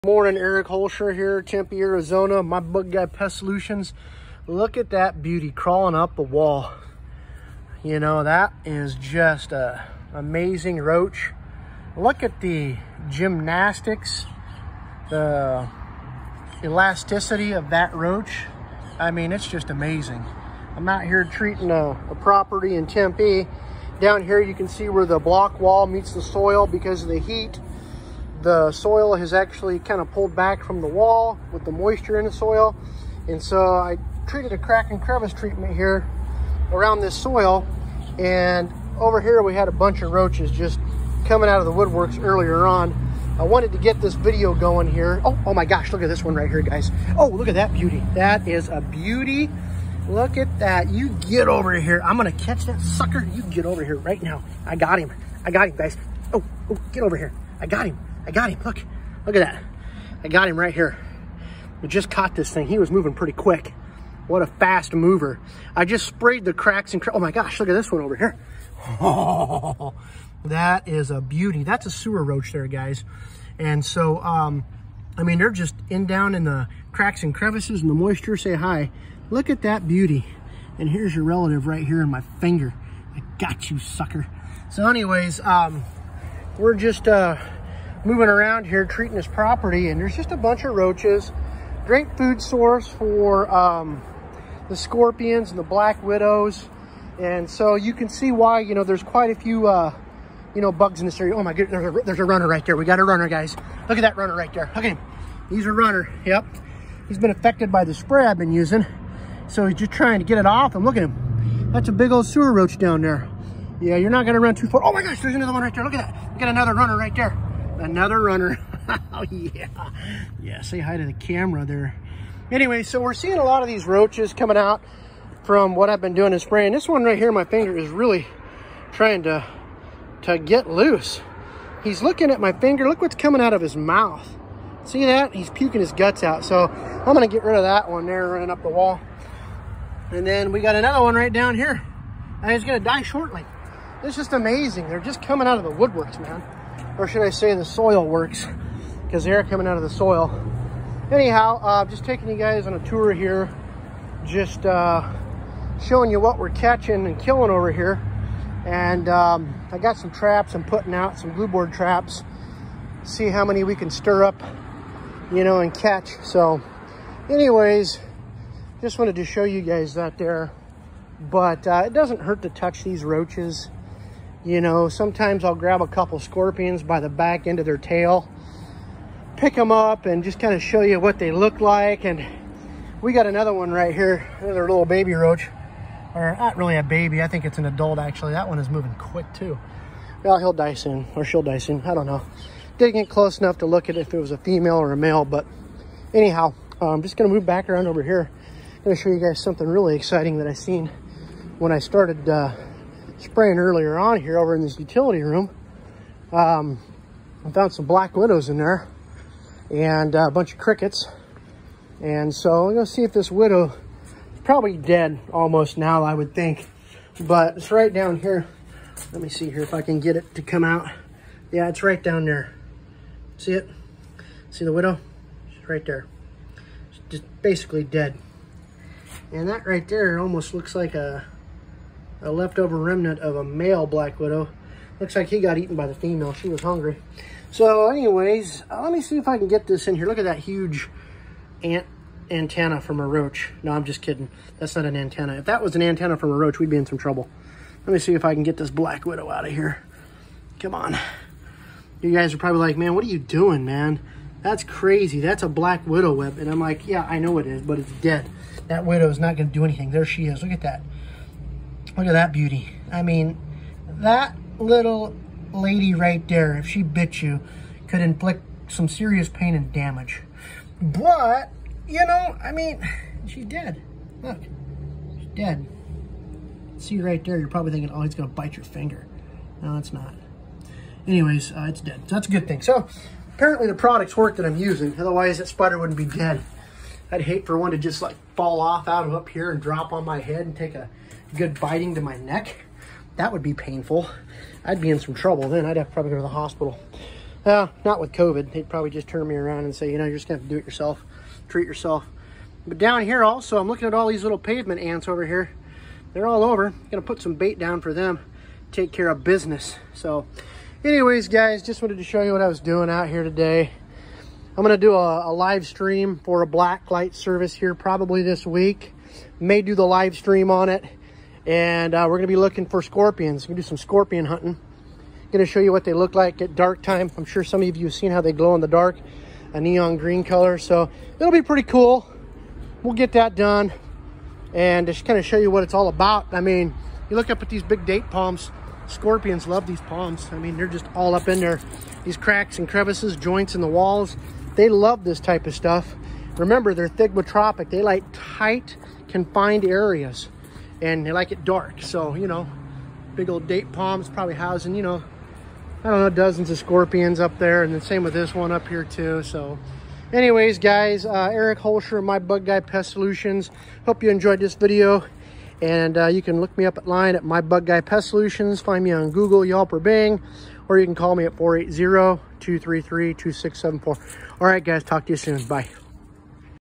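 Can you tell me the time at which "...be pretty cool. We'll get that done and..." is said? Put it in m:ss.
5:31.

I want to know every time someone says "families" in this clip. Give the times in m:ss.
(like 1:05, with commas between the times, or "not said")
not said.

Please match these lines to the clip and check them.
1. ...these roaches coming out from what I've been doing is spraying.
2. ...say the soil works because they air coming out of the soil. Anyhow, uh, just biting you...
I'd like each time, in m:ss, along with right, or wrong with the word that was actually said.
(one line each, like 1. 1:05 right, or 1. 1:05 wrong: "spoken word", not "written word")
1. 2:03 right
2. 2:27 wrong: "taking", not "biting".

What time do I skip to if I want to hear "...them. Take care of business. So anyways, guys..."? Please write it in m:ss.
5:07.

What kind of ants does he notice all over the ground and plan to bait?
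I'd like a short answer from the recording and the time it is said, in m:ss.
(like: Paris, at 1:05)
Pavement ants, at 5:04.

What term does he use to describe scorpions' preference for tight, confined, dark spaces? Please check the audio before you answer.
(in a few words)
Thigmotropic.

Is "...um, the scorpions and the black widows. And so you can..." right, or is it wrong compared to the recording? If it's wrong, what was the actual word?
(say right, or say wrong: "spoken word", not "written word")
right.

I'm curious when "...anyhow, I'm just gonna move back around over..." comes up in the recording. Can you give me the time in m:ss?
3:16.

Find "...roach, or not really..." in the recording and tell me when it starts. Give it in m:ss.
3:05.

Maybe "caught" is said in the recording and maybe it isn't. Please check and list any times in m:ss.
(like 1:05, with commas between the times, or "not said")
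1:02.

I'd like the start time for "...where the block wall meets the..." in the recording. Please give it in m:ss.
0:24.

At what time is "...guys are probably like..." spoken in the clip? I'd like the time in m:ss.
4:12.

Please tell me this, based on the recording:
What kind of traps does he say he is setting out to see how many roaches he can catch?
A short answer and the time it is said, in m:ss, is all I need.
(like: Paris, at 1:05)
Glue board traps, at 2:41.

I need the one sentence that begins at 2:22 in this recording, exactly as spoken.
And he's going to die shortly.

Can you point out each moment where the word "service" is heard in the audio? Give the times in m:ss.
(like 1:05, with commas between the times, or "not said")
5:17.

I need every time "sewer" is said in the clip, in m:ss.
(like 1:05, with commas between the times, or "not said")
1:11, 1:52.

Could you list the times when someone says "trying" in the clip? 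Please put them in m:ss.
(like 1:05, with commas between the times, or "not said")
1:49, 2:08.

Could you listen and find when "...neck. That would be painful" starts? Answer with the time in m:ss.
4:52.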